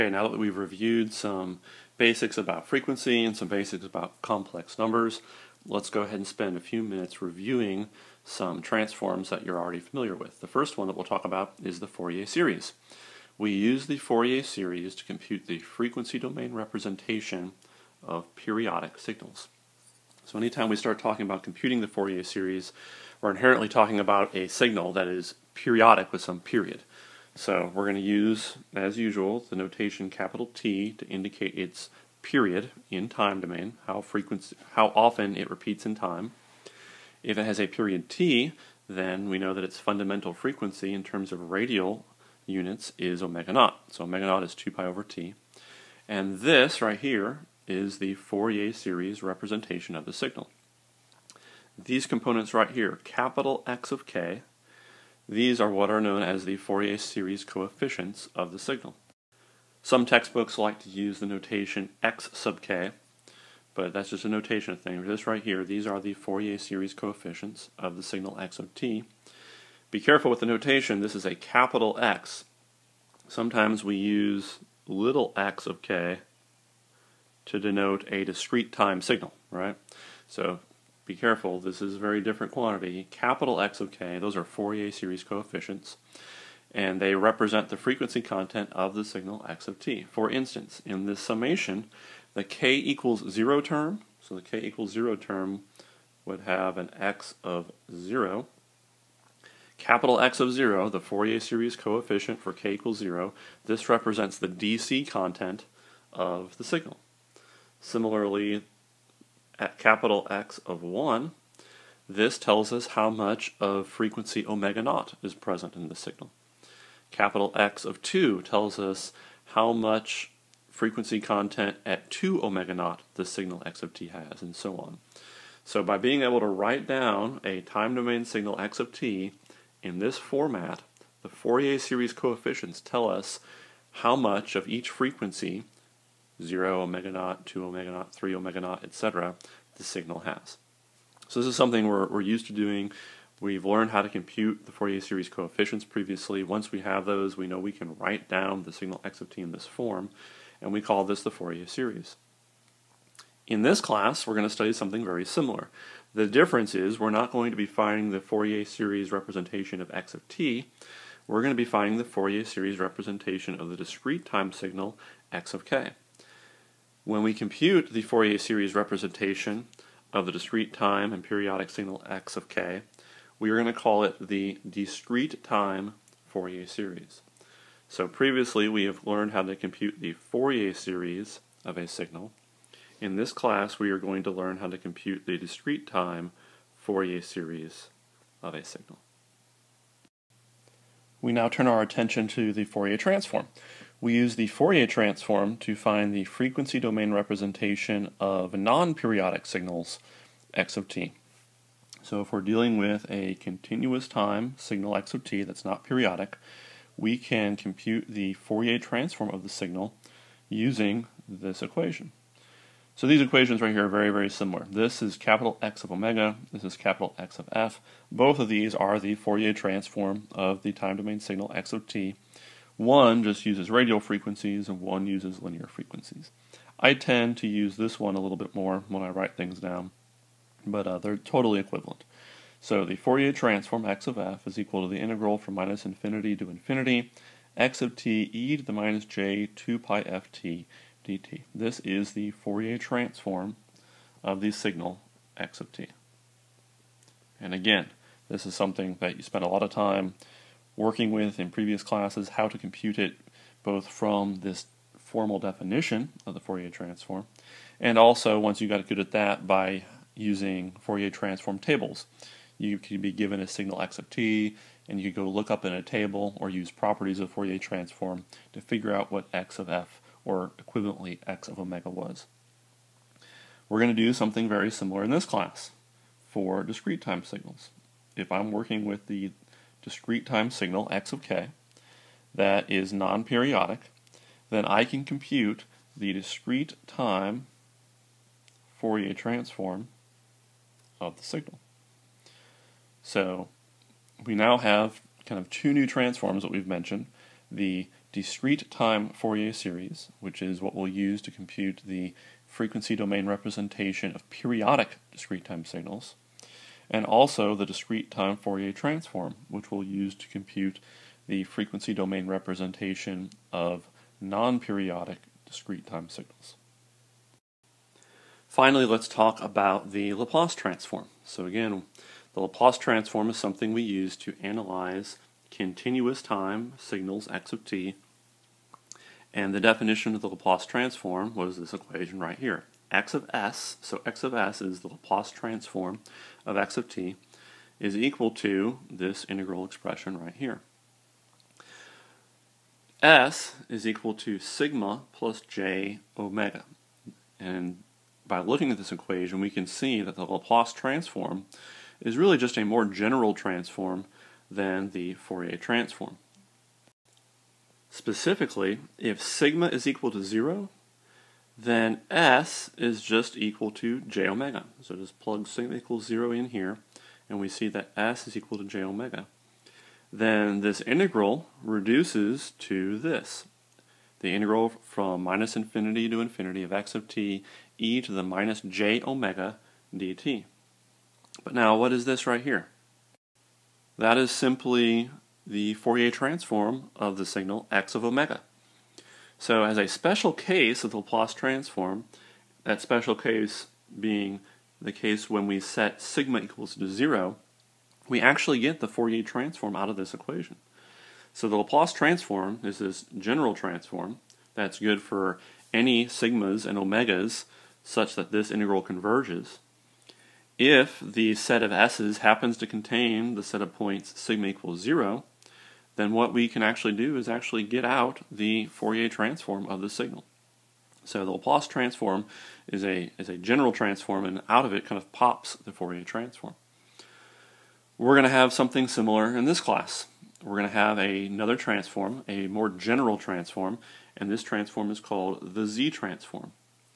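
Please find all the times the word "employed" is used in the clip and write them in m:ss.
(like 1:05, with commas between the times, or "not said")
not said.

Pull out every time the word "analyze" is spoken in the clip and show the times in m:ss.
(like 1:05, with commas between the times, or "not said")
5:24.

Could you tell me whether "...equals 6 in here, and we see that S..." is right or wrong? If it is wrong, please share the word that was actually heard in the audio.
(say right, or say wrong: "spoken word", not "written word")
wrong: "0", not "6".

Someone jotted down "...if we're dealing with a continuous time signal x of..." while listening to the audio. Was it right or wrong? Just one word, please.
right.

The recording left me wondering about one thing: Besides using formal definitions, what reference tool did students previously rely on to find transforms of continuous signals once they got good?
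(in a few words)
Fourier transform tables.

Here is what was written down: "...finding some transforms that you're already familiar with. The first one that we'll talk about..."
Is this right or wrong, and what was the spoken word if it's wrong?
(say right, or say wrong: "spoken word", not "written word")
wrong: "reviewing", not "finding".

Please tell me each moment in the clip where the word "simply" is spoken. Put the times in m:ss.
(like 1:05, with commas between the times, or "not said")
6:24.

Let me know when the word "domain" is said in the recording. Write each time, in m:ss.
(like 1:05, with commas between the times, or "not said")
0:16, 0:33, 2:07, 3:16, 3:40, 5:02, 5:11.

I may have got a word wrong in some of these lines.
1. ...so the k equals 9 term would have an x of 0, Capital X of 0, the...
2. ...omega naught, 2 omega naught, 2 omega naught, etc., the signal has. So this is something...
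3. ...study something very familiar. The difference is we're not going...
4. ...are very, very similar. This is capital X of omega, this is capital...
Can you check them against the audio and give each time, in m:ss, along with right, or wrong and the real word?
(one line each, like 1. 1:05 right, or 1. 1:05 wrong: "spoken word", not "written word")
1. 1:34 wrong: "0", not "9"
2. 2:16 wrong: "3", not "2"
3. 2:34 wrong: "similar", not "familiar"
4. 3:33 right.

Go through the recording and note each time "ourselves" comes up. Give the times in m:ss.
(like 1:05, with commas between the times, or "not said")
not said.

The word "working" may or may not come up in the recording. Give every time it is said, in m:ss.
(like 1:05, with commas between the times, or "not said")
4:10, 4:38.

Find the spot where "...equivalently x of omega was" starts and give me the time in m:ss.
4:30.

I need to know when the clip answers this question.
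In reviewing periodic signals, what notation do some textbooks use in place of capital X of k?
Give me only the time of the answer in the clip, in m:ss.
1:02.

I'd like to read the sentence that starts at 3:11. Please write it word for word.
We now turn our attention to the Fourier transform.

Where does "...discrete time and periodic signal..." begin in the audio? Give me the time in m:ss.
2:50.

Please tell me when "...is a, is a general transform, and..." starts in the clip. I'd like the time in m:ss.
7:02.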